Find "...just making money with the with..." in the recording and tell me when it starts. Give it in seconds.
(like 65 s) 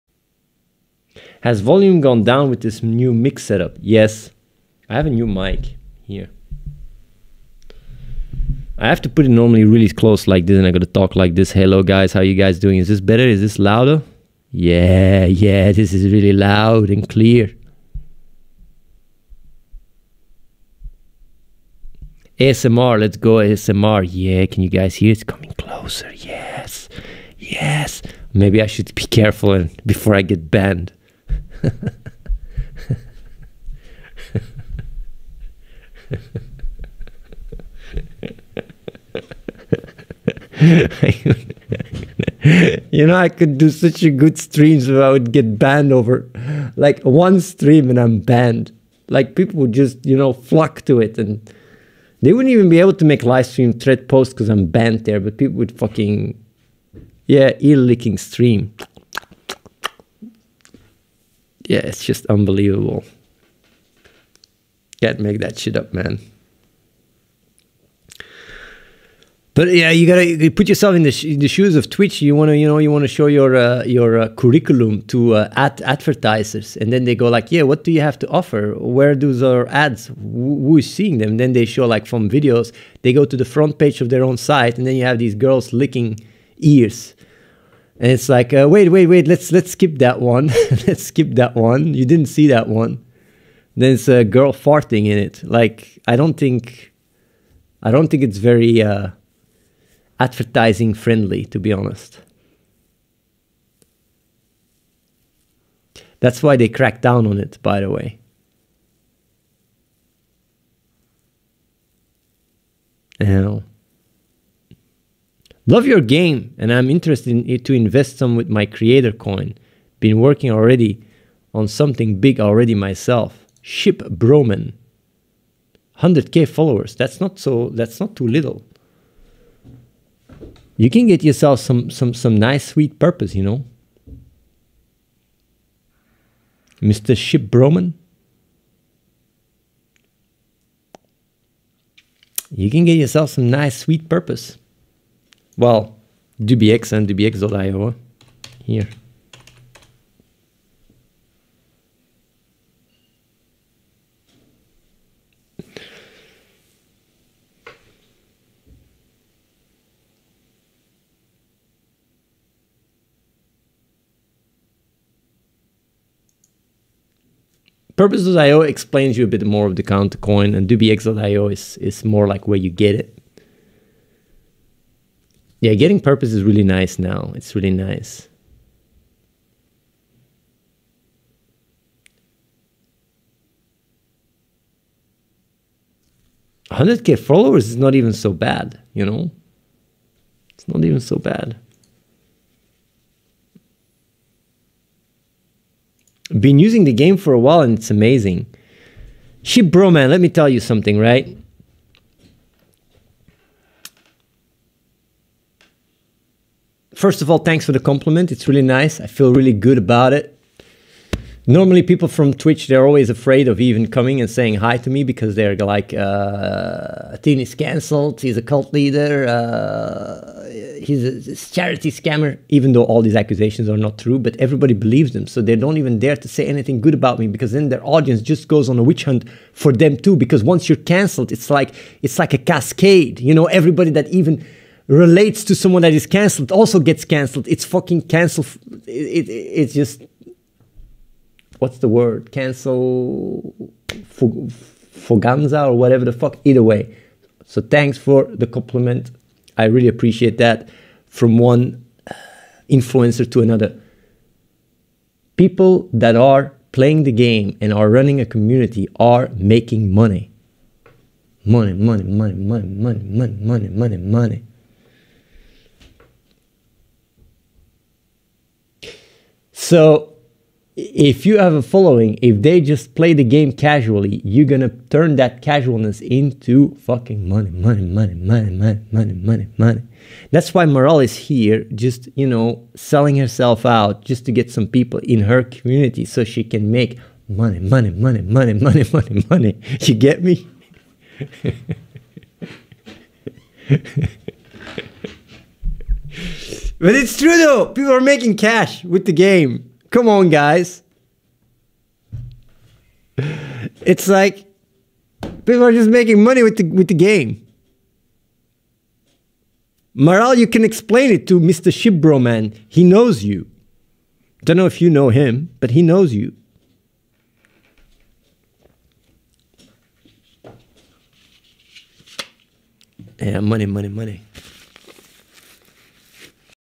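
305 s.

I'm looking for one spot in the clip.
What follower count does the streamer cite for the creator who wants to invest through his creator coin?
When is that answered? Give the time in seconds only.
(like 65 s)
125 s.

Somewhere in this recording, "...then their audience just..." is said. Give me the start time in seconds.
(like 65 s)
227 s.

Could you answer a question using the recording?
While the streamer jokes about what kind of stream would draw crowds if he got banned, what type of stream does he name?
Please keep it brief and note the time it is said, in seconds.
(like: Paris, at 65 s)
ear licking stream, at 57 s.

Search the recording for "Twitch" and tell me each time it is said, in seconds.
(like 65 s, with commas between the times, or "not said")
71 s, 212 s.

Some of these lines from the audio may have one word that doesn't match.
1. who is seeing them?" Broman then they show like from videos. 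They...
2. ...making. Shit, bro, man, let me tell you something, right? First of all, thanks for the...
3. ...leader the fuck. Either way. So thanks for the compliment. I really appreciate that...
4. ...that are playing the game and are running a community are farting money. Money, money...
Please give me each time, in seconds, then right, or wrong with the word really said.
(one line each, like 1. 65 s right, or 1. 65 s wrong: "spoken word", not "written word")
1. 80 s wrong: "And", not "Broman"
2. 197 s wrong: "amazing", not "making"
3. 245 s wrong: "whatever", not "leader"
4. 255 s wrong: "making", not "farting".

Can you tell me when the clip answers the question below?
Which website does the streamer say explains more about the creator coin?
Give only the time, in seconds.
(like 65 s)
167 s.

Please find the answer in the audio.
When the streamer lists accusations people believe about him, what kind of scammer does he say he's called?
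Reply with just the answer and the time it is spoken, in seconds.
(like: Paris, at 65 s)
charity scammer, at 221 s.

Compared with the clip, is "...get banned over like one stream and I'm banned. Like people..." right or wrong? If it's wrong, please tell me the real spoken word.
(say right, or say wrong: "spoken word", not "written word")
right.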